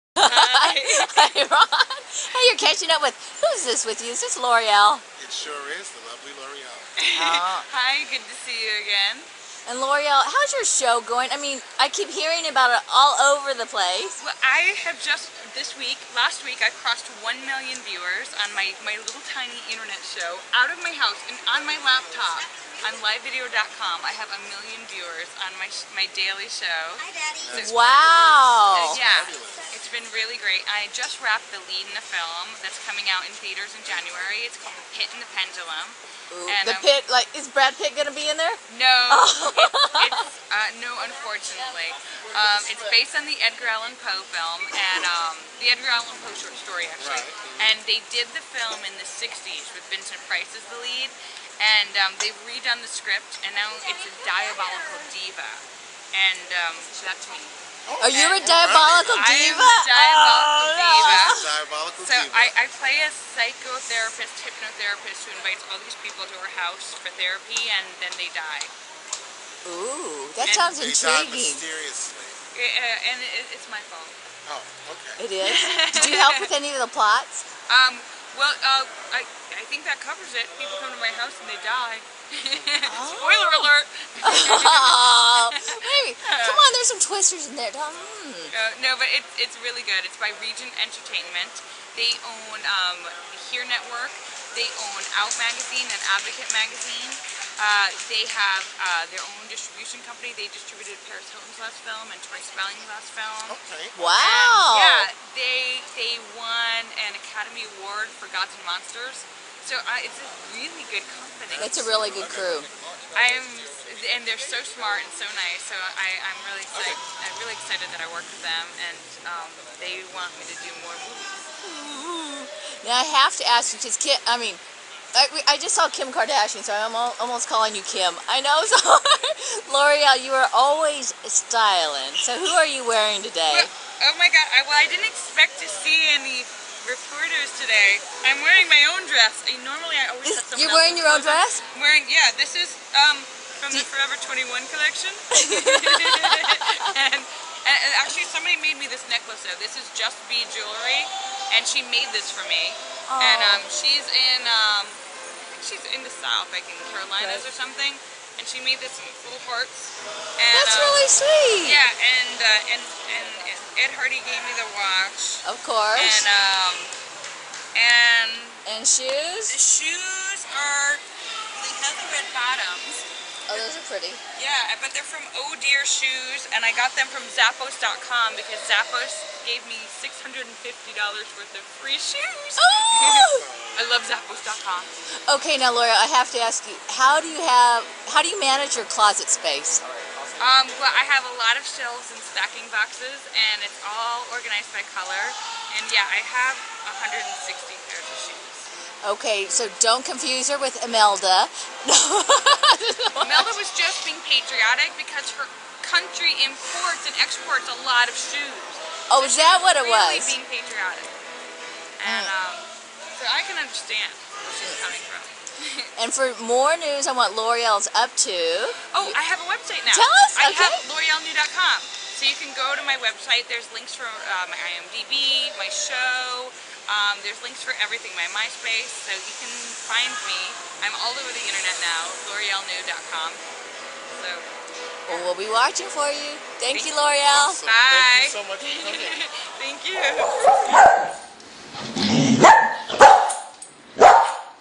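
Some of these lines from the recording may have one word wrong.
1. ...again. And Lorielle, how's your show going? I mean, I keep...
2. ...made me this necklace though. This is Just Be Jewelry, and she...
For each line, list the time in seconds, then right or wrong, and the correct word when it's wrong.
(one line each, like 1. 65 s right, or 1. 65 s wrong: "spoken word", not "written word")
1. 8 s right
2. 148 s right.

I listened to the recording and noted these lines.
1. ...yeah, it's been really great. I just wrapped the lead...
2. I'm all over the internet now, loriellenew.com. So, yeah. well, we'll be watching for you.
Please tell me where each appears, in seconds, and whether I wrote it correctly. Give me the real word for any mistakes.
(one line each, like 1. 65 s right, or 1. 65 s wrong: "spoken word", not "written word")
1. 28 s right
2. 230 s right.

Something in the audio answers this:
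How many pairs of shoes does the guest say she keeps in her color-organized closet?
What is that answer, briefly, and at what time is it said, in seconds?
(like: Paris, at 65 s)
160, at 197 s.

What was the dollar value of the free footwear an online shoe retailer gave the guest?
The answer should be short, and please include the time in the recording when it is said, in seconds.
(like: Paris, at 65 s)
$650, at 180 s.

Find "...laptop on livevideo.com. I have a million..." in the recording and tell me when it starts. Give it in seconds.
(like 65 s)
21 s.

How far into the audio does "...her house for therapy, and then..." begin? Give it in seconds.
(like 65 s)
66 s.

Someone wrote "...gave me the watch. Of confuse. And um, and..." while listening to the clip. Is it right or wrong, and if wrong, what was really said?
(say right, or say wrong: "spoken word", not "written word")
wrong: "course", not "confuse".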